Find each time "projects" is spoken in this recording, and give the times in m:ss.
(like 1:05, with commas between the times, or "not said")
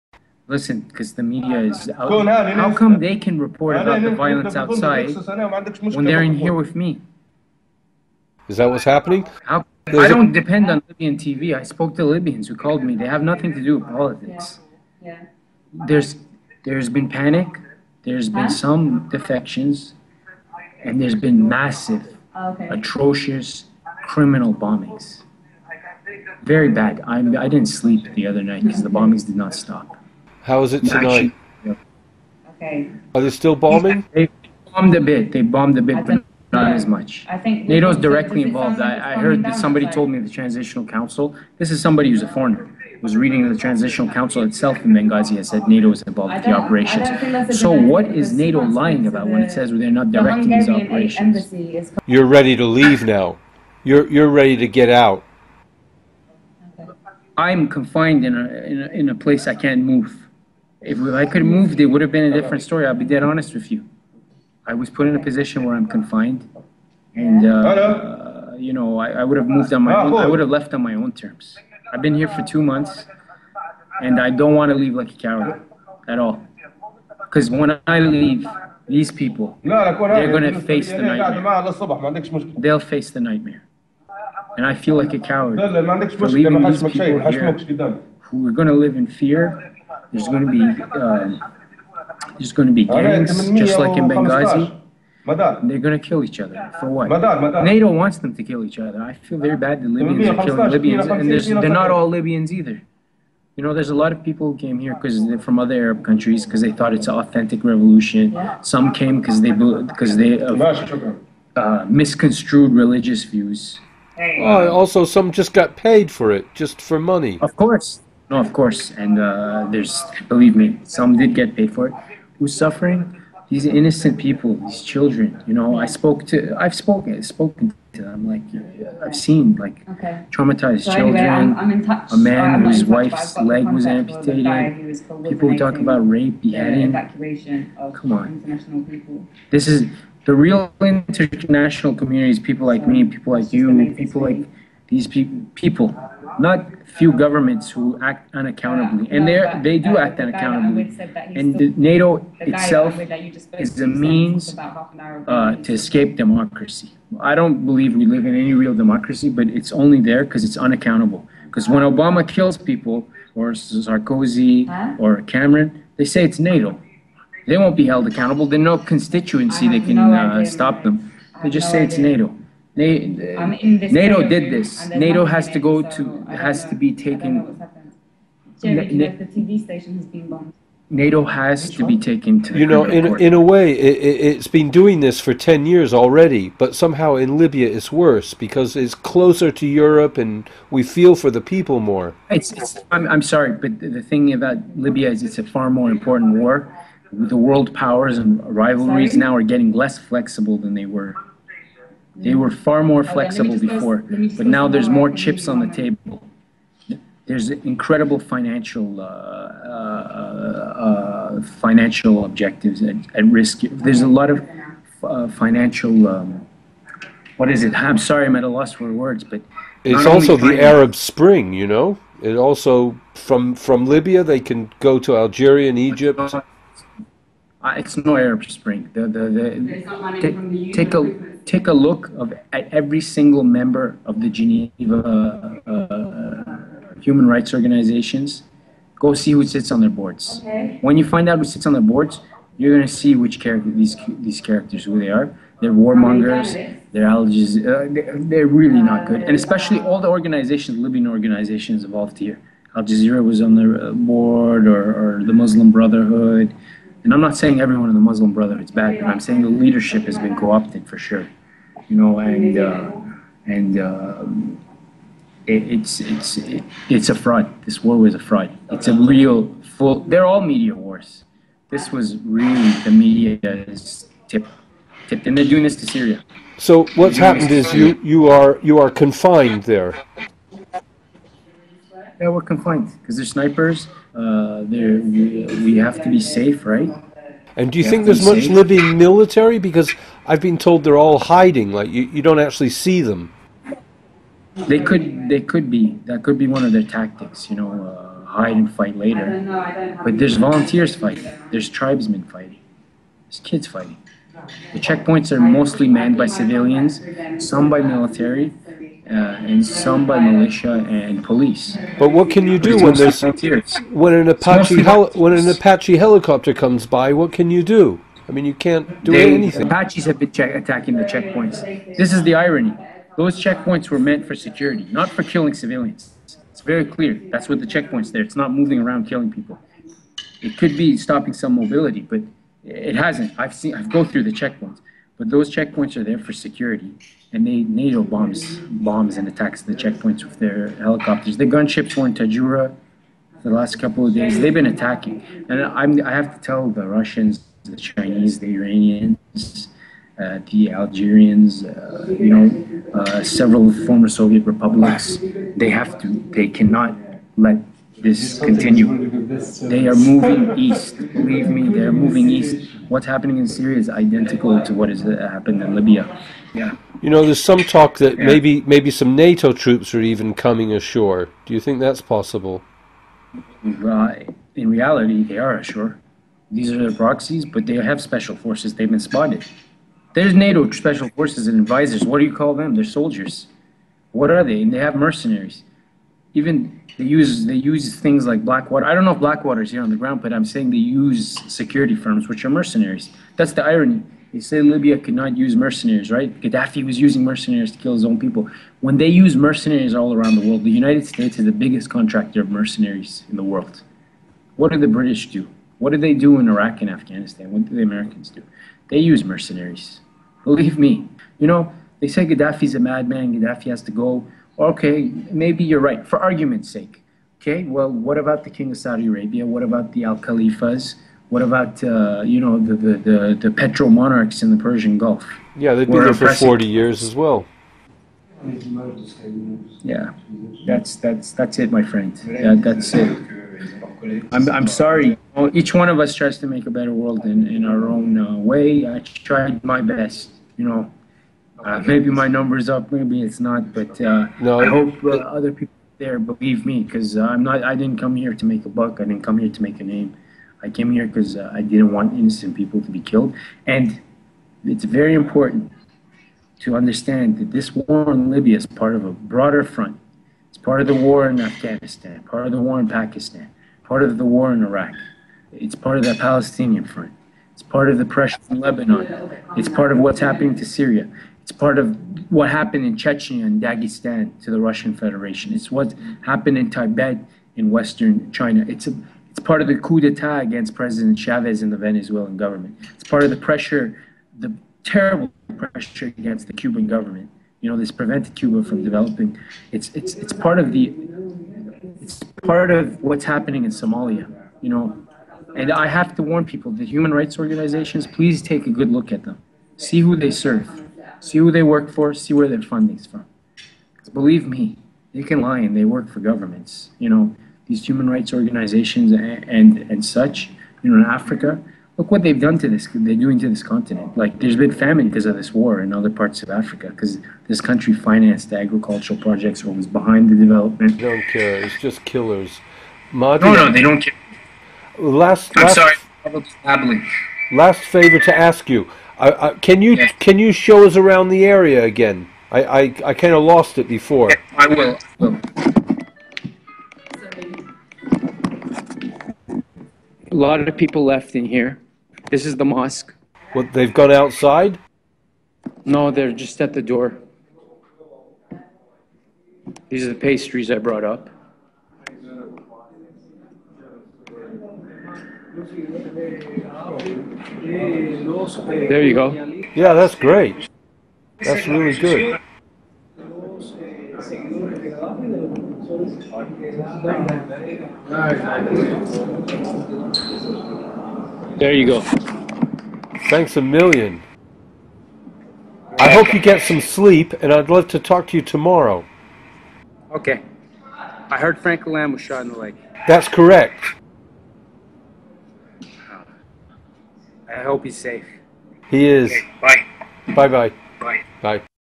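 8:39.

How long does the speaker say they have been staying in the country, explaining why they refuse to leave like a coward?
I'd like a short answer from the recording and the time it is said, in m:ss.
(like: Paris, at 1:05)
two months, at 1:12.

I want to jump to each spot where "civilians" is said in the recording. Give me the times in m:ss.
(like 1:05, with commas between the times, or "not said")
5:06, 5:25.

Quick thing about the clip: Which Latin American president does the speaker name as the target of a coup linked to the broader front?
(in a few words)
Chavez.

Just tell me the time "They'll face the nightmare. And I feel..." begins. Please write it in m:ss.
1:22.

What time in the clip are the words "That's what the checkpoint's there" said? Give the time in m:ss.
5:27.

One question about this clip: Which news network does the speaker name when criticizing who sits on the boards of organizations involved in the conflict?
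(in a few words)
Al Jazeera.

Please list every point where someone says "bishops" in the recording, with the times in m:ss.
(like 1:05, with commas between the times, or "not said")
not said.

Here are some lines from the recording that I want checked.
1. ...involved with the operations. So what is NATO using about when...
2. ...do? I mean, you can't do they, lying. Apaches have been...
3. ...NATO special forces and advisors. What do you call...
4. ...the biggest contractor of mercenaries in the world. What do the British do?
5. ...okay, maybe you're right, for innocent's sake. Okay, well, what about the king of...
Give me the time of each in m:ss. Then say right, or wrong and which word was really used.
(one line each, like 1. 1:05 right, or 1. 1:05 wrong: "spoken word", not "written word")
1. 0:46 wrong: "lying", not "using"
2. 5:17 wrong: "anything", not "lying"
3. 6:20 right
4. 6:41 right
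5. 6:54 wrong: "argument", not "innocent".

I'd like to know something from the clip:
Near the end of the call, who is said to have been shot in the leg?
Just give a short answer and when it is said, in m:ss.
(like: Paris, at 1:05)
Frank Lamb, at 9:41.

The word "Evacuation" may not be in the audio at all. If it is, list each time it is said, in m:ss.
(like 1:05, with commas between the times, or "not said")
2:16.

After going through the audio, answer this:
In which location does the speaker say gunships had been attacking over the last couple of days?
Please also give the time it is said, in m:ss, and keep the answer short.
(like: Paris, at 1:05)
Tajura, at 5:42.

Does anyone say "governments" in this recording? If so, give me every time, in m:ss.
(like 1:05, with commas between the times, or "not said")
2:27, 8:02, 8:06, 8:26.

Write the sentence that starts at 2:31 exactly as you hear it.
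And NATO itself is a means uh, to escape democracy.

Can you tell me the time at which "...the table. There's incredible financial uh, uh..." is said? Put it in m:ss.
3:25.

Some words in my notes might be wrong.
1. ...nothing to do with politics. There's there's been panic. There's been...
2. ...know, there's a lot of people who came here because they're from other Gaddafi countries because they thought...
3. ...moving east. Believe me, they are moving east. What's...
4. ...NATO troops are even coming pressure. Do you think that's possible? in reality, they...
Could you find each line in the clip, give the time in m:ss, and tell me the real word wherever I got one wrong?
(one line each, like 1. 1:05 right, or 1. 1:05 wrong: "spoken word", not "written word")
1. 0:13 right
2. 1:43 wrong: "Arab", not "Gaddafi"
3. 5:59 right
4. 6:09 wrong: "ashore", not "pressure".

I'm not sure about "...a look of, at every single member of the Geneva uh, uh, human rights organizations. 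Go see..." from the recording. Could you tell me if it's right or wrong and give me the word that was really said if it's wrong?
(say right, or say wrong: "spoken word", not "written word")
right.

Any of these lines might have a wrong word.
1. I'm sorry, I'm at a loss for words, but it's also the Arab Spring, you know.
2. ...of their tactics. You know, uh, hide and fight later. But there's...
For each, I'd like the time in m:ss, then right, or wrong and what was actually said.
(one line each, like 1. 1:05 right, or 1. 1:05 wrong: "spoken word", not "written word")
1. 3:37 right
2. 4:56 right.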